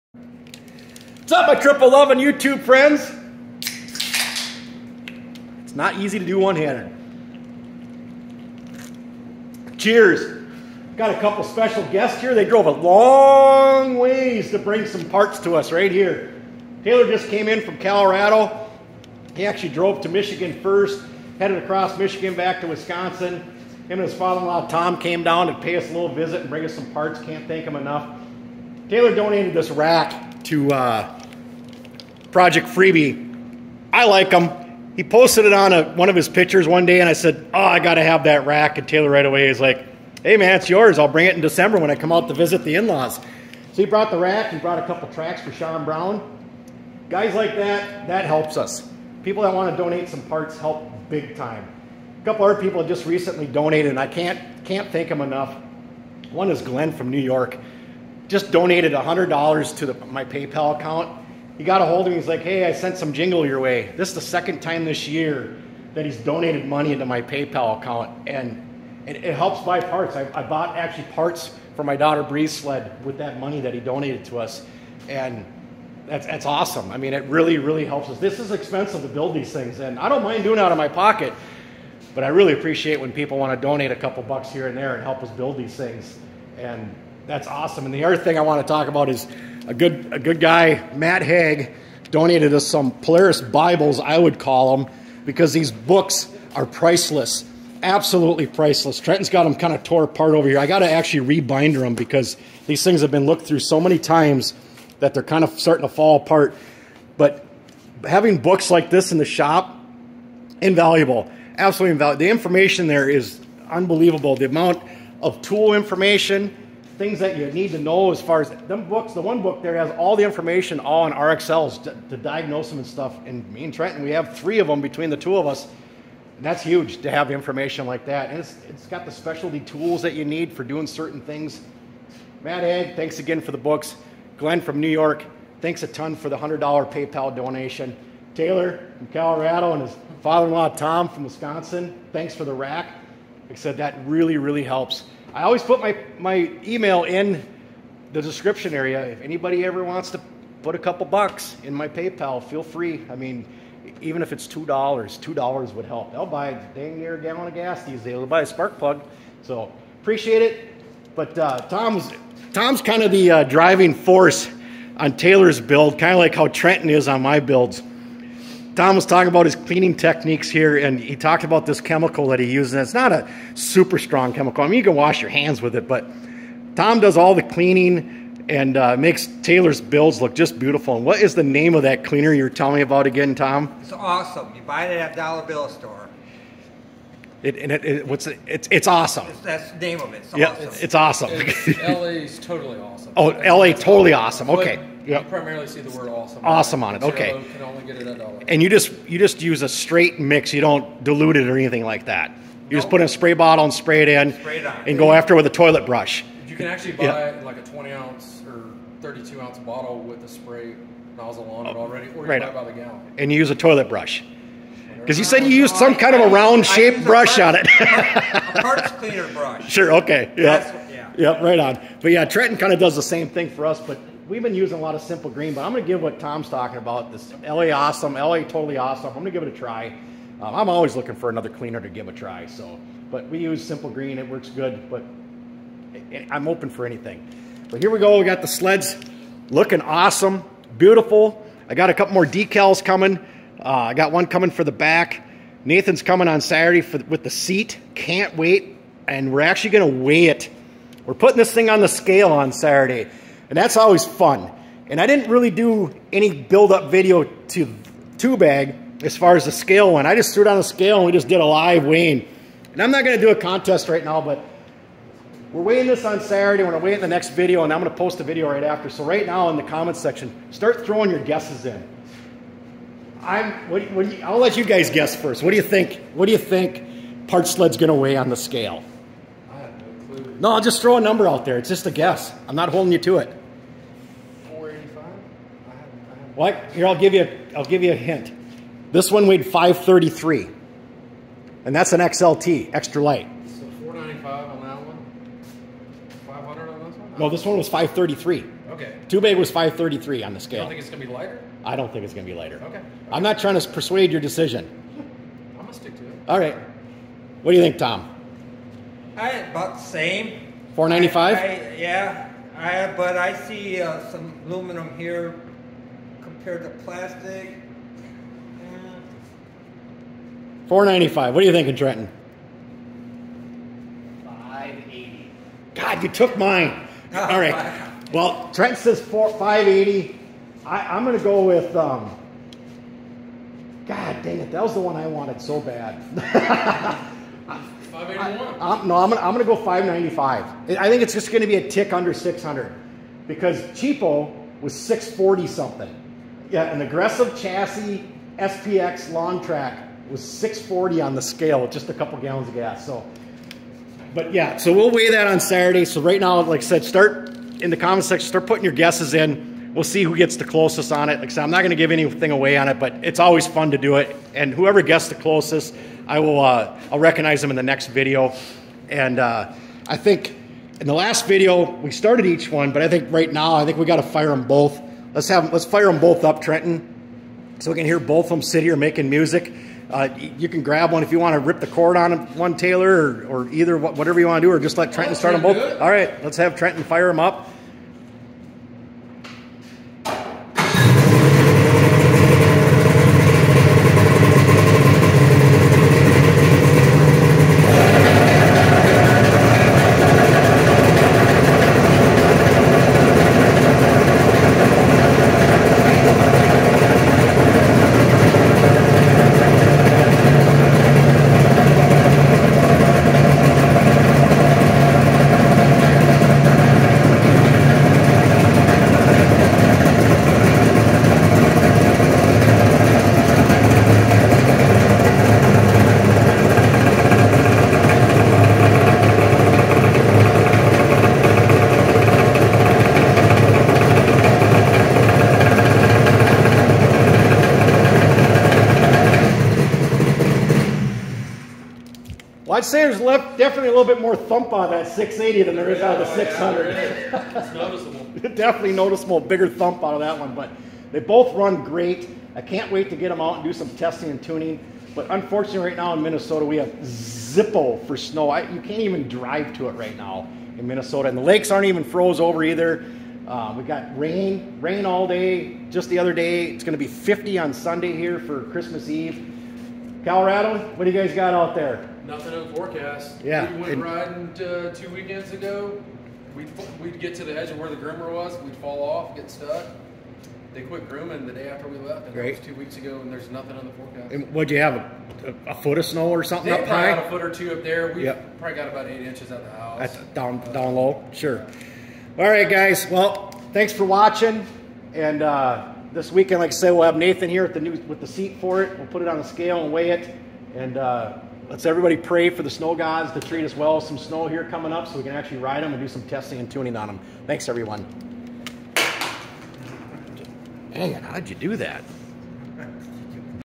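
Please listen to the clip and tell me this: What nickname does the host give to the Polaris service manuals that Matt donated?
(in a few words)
Polaris Bibles.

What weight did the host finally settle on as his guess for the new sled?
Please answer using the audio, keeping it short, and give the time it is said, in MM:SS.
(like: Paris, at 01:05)
595, at 05:39.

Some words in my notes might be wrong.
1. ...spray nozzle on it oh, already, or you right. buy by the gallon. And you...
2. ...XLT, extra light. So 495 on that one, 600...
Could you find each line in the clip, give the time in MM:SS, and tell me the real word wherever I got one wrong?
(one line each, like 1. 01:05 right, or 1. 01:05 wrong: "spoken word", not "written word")
1. 03:30 right
2. 04:52 wrong: "500", not "600".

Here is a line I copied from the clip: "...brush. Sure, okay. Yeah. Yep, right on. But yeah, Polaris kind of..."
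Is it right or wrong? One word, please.
wrong.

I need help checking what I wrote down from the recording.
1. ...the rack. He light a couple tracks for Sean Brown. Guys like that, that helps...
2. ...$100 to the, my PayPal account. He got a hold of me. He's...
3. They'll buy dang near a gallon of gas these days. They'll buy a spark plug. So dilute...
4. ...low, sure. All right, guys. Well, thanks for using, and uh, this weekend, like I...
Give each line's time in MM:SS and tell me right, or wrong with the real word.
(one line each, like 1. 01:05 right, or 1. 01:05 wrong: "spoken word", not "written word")
1. 00:44 wrong: "brought", not "light"
2. 00:58 right
3. 02:36 wrong: "appreciate", not "dilute"
4. 08:10 wrong: "watching", not "using".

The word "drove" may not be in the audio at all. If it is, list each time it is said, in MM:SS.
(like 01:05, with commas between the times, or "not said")
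00:12, 00:19.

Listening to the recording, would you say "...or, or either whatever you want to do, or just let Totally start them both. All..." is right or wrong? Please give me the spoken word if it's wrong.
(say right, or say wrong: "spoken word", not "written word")
wrong: "Trenton", not "Totally".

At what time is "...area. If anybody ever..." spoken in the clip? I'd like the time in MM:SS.
02:28.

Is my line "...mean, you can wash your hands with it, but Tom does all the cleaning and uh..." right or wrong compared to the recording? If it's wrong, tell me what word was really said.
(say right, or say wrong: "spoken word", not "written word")
right.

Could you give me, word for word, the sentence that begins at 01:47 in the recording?
But having books like this in the shop, invaluable, absolutely invaluable.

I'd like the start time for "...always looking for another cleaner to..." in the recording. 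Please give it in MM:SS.
03:50.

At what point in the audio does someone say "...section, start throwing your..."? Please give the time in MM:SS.
04:29.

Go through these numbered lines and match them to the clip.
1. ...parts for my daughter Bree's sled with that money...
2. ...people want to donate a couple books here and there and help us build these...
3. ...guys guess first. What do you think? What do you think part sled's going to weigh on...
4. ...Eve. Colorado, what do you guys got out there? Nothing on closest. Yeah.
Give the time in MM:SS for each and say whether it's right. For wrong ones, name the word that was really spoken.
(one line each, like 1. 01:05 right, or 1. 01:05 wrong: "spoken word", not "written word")
1. 01:11 right
2. 01:23 wrong: "bucks", not "books"
3. 04:34 right
4. 07:48 wrong: "forecast", not "closest".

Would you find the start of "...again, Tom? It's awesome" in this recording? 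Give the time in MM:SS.
03:03.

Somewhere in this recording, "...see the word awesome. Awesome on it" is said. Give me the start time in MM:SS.
03:15.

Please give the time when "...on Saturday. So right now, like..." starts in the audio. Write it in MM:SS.
05:55.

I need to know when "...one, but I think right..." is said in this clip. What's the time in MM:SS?
06:12.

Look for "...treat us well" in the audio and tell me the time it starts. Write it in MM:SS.
08:23.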